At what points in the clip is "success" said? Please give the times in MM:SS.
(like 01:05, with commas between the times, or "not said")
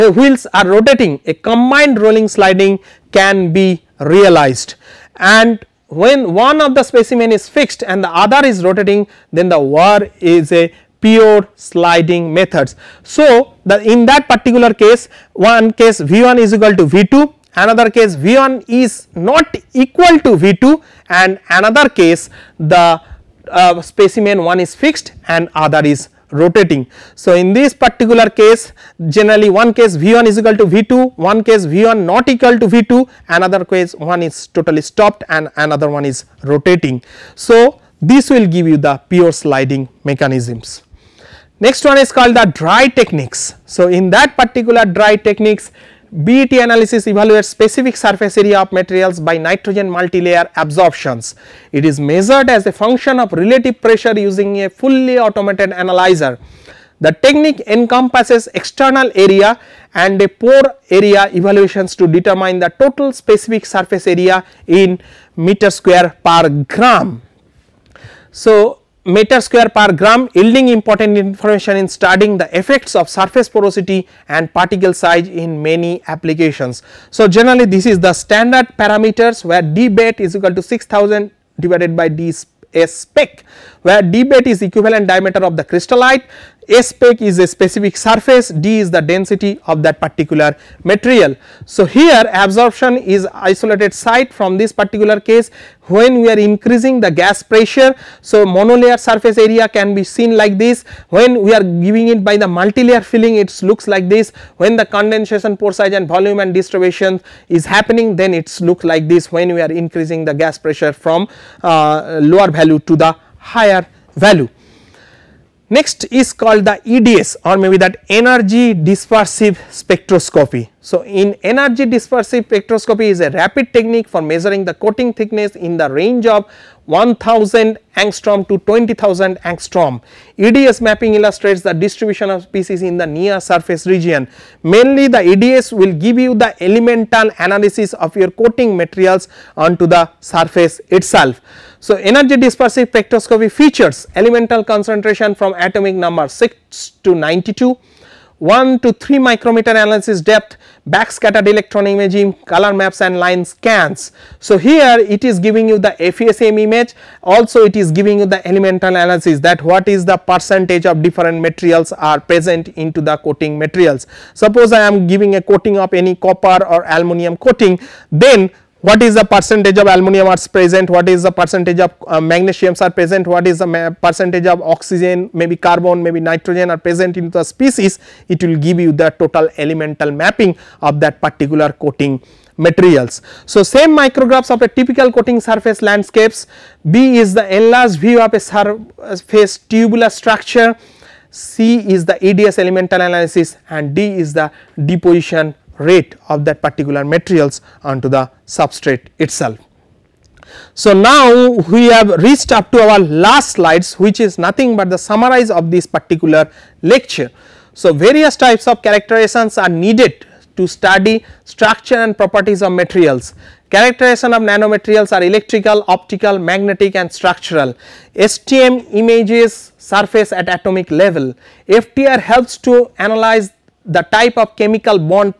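not said.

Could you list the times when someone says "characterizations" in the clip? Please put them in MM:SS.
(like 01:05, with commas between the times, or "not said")
03:28, 03:33.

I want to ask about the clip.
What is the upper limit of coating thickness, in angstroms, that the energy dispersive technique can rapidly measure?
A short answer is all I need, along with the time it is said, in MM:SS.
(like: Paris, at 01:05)
20000 angstrom, at 02:08.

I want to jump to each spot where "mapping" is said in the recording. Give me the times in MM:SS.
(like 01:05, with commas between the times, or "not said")
02:10, 03:00.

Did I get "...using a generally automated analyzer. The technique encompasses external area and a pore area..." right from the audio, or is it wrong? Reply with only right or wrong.
wrong.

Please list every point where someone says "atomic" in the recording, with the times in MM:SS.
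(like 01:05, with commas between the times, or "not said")
02:25, 03:40.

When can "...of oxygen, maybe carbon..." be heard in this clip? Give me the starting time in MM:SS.
02:54.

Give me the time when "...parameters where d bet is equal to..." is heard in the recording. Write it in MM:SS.
01:18.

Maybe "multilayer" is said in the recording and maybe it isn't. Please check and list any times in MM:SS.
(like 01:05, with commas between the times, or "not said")
00:49, 01:42.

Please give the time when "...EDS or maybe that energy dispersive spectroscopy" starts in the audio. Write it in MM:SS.
01:56.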